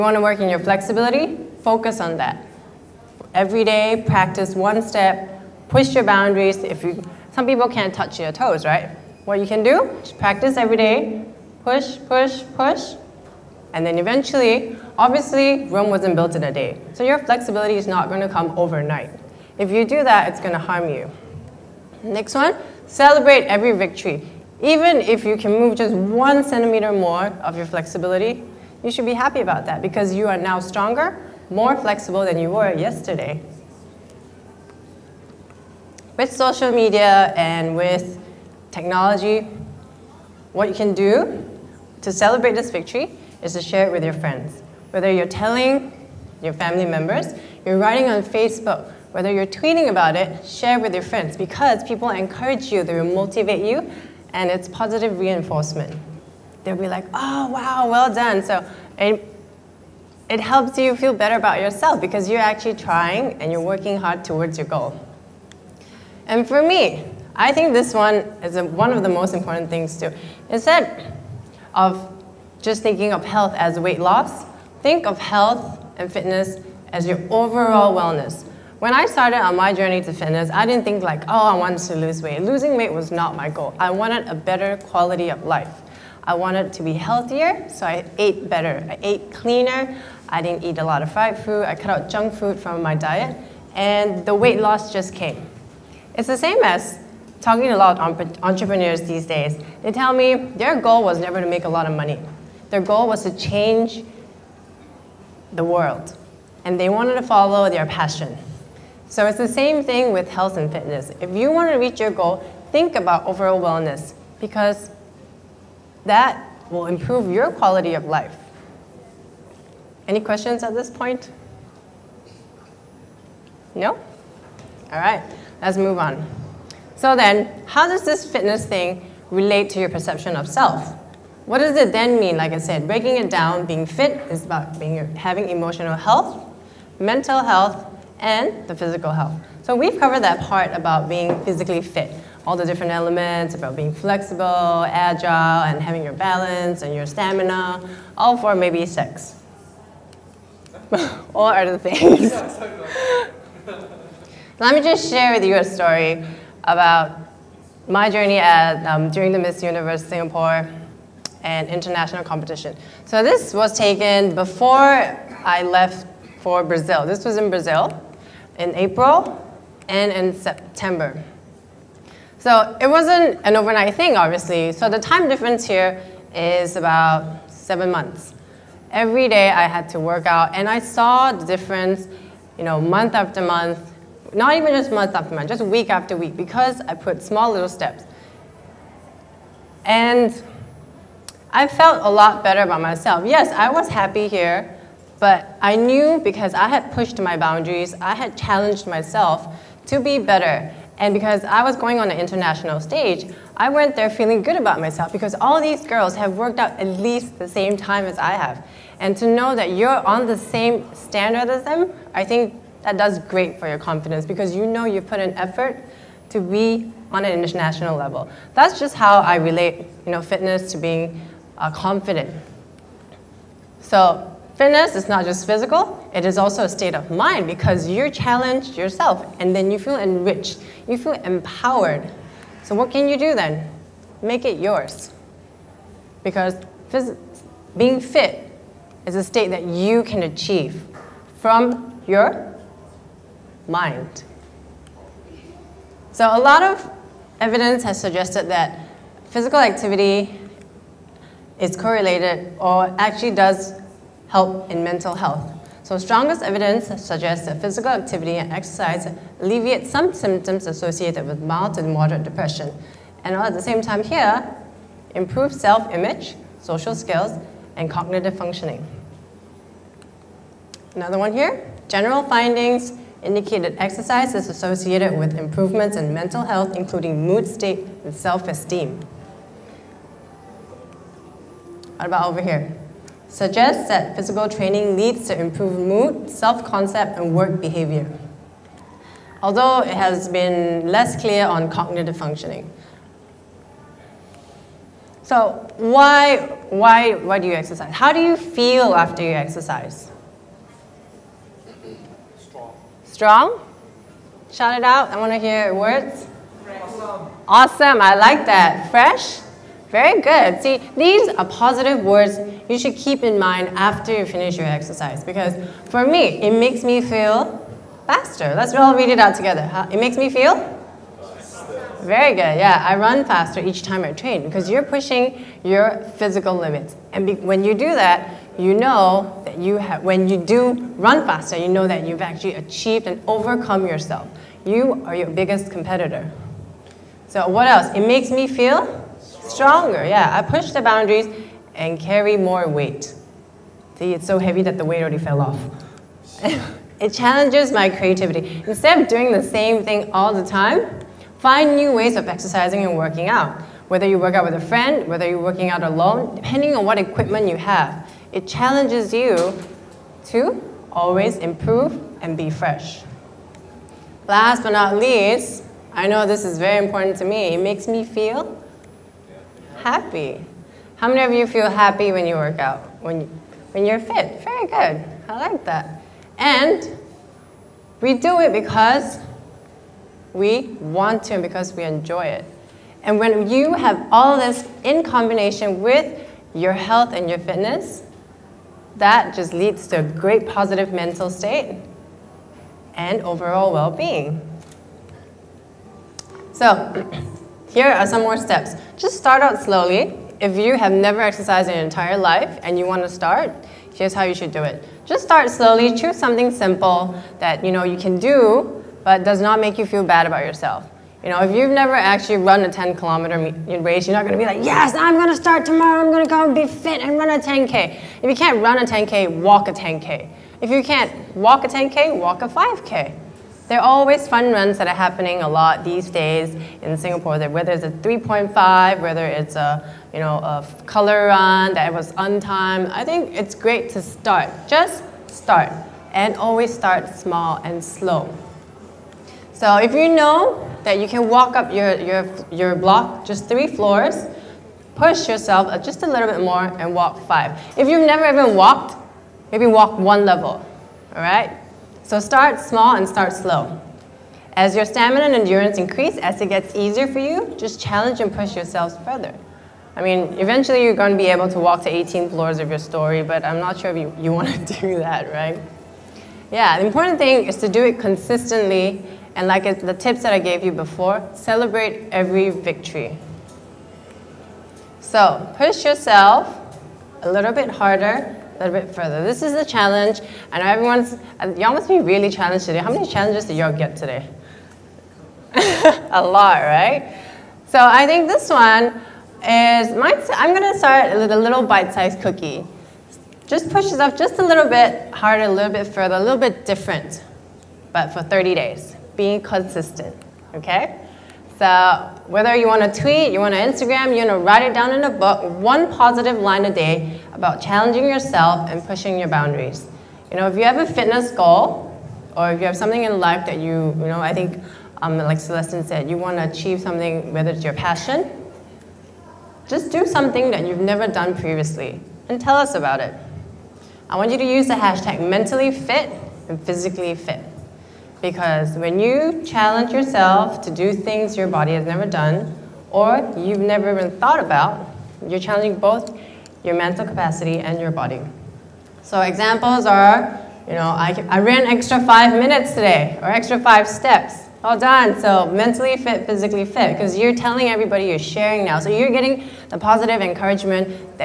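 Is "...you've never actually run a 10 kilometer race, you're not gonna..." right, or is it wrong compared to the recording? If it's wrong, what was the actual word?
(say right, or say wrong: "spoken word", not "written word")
right.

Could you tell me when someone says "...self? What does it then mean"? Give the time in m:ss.
2:10.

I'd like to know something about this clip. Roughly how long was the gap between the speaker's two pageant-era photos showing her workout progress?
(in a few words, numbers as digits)
7 months.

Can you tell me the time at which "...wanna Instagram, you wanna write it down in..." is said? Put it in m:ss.
8:23.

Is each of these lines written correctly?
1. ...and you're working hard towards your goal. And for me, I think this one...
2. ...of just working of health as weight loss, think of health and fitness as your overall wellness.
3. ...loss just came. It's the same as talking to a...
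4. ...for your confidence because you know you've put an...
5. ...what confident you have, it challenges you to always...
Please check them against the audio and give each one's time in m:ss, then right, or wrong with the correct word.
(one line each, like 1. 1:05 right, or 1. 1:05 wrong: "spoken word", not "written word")
1. 1:03 right
2. 1:11 wrong: "thinking", not "working"
3. 1:34 right
4. 3:33 right
5. 5:56 wrong: "equipment", not "confident".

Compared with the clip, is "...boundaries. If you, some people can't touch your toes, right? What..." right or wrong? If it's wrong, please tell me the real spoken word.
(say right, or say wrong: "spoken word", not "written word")
right.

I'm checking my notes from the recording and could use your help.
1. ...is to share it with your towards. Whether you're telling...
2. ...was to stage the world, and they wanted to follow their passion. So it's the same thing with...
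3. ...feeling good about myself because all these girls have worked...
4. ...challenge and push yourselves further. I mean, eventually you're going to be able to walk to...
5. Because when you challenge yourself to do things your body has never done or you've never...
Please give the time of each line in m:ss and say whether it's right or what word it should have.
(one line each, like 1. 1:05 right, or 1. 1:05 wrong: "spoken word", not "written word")
1. 0:43 wrong: "friends", not "towards"
2. 1:43 wrong: "change", not "stage"
3. 3:24 right
4. 7:37 right
5. 8:48 right.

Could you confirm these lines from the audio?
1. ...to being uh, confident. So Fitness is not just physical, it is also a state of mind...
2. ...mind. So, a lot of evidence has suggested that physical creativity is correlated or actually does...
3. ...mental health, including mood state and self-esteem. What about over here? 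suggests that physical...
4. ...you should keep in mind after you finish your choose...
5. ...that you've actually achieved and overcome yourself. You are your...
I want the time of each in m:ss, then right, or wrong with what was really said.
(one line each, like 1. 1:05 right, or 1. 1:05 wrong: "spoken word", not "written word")
1. 3:40 right
2. 4:03 wrong: "activity", not "creativity"
3. 4:36 right
4. 5:12 wrong: "exercise", not "choose"
5. 5:31 right.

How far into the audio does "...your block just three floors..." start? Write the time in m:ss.
7:22.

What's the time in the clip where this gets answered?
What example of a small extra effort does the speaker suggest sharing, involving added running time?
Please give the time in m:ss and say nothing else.
9:01.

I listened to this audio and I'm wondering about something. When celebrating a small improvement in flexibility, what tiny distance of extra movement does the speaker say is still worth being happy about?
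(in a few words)
1 centimeter.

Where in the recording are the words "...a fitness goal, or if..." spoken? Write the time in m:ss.
8:30.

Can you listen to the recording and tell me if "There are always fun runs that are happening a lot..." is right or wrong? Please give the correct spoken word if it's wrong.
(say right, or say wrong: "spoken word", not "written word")
right.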